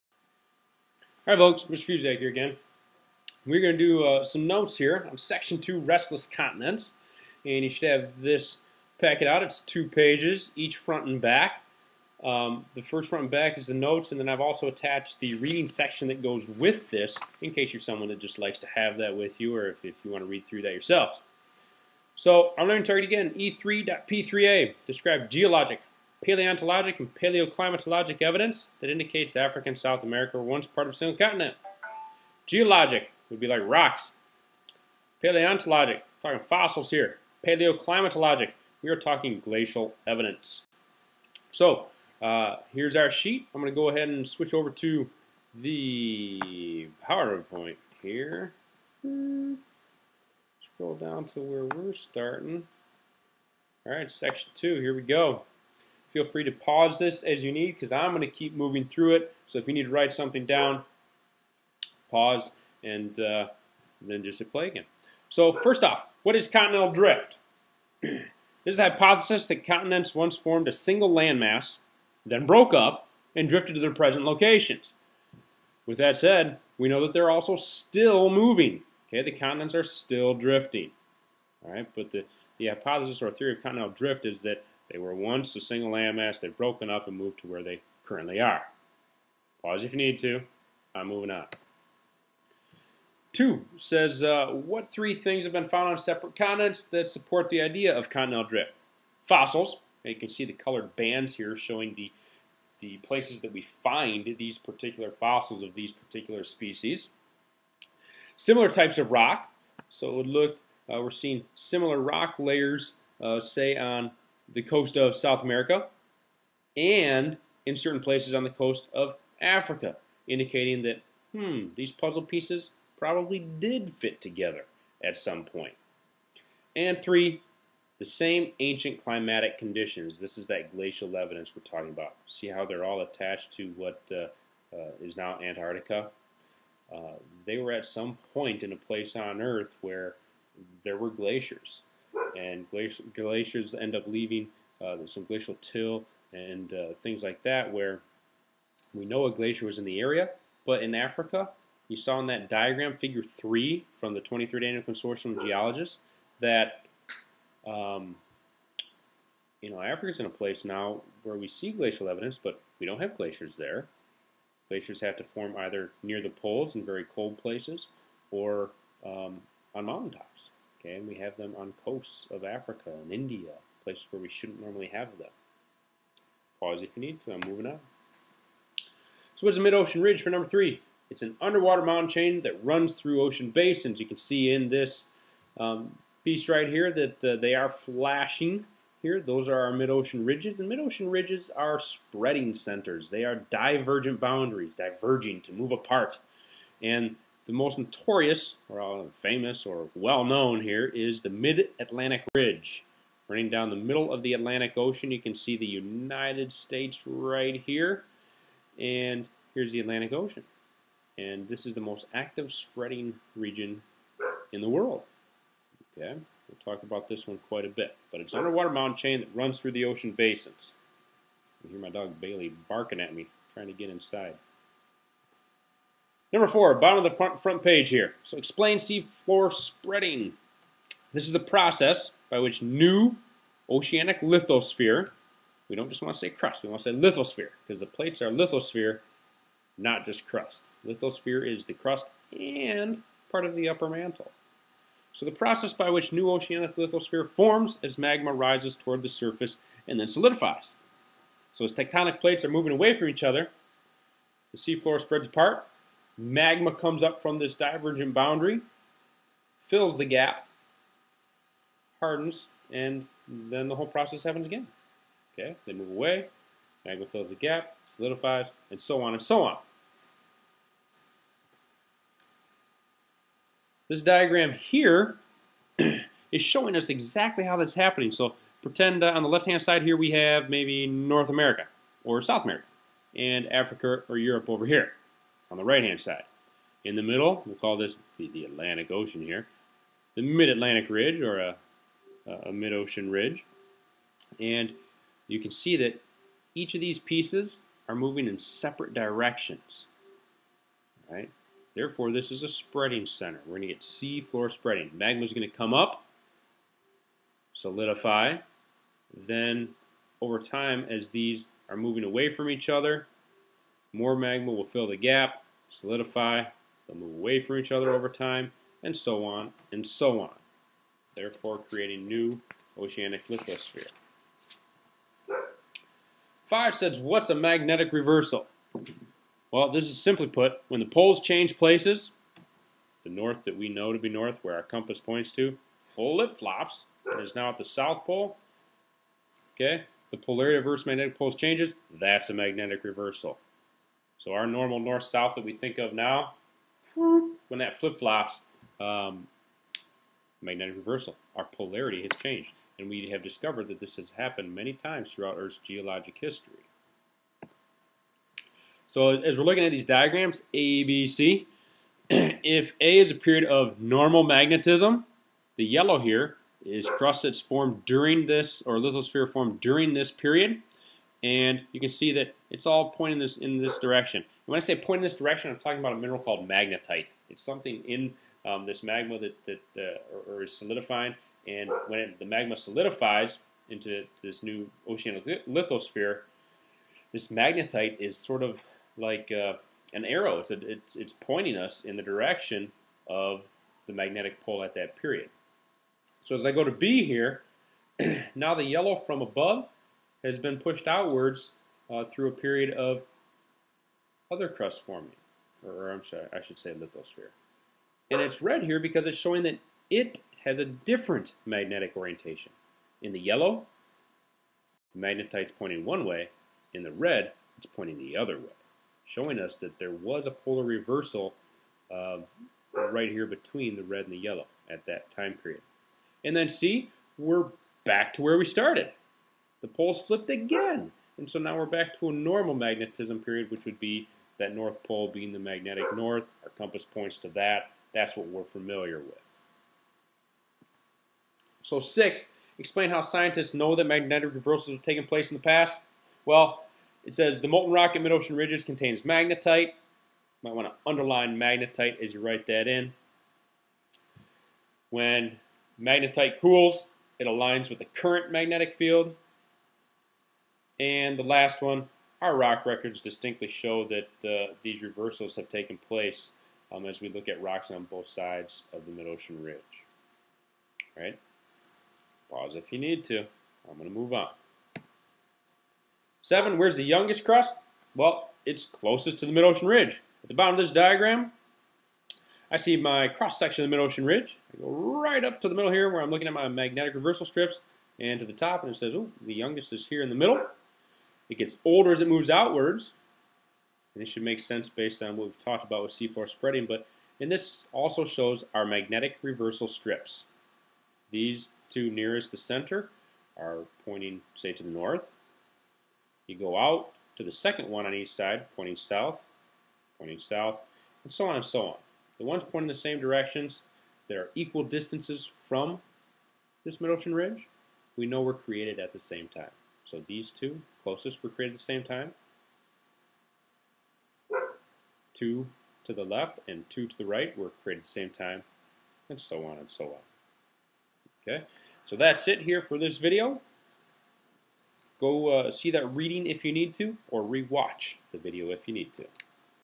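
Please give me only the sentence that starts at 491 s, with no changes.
It gets older as it moves outwards.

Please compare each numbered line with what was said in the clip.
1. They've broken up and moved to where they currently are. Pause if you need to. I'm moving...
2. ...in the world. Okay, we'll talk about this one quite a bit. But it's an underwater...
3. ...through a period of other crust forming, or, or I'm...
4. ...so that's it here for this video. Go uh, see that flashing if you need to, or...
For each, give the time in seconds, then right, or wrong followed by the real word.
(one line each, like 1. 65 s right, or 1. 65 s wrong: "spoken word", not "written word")
1. 86 s right
2. 214 s right
3. 402 s right
4. 531 s wrong: "reading", not "flashing".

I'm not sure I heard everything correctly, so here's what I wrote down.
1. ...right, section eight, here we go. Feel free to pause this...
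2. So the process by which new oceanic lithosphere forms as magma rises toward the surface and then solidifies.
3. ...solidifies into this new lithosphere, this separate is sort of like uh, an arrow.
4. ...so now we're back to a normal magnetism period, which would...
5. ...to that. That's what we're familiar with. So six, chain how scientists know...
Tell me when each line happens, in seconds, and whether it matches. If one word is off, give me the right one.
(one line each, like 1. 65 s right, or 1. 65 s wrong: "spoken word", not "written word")
1. 53 s wrong: "two", not "eight"
2. 245 s right
3. 382 s wrong: "magnetite", not "separate"
4. 431 s right
5. 437 s wrong: "explain", not "chain".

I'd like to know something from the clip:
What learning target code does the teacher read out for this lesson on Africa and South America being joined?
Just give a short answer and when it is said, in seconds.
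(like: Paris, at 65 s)
E3.P3A, at 23 s.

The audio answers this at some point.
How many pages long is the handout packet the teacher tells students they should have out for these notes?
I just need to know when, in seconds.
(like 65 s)
9 s.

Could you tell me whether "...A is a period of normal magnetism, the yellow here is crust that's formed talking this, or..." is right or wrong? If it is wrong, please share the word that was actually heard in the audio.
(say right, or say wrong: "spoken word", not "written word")
wrong: "during", not "talking".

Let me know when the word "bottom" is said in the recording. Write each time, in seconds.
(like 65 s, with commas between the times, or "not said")
226 s, 480 s.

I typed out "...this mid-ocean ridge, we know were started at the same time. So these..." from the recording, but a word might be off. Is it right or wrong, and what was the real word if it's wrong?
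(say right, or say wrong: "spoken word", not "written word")
wrong: "created", not "started".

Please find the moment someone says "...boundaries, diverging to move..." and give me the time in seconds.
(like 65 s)
194 s.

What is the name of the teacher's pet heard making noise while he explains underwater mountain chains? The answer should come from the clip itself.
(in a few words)
Bailey.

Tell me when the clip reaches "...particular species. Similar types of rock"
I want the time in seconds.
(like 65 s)
105 s.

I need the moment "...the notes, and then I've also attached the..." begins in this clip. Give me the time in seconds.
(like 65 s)
13 s.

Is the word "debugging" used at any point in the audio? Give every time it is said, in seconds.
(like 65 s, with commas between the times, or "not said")
not said.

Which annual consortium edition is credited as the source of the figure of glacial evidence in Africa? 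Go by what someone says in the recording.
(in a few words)
23rd.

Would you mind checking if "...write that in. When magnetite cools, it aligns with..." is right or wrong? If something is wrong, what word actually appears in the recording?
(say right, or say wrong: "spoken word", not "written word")
right.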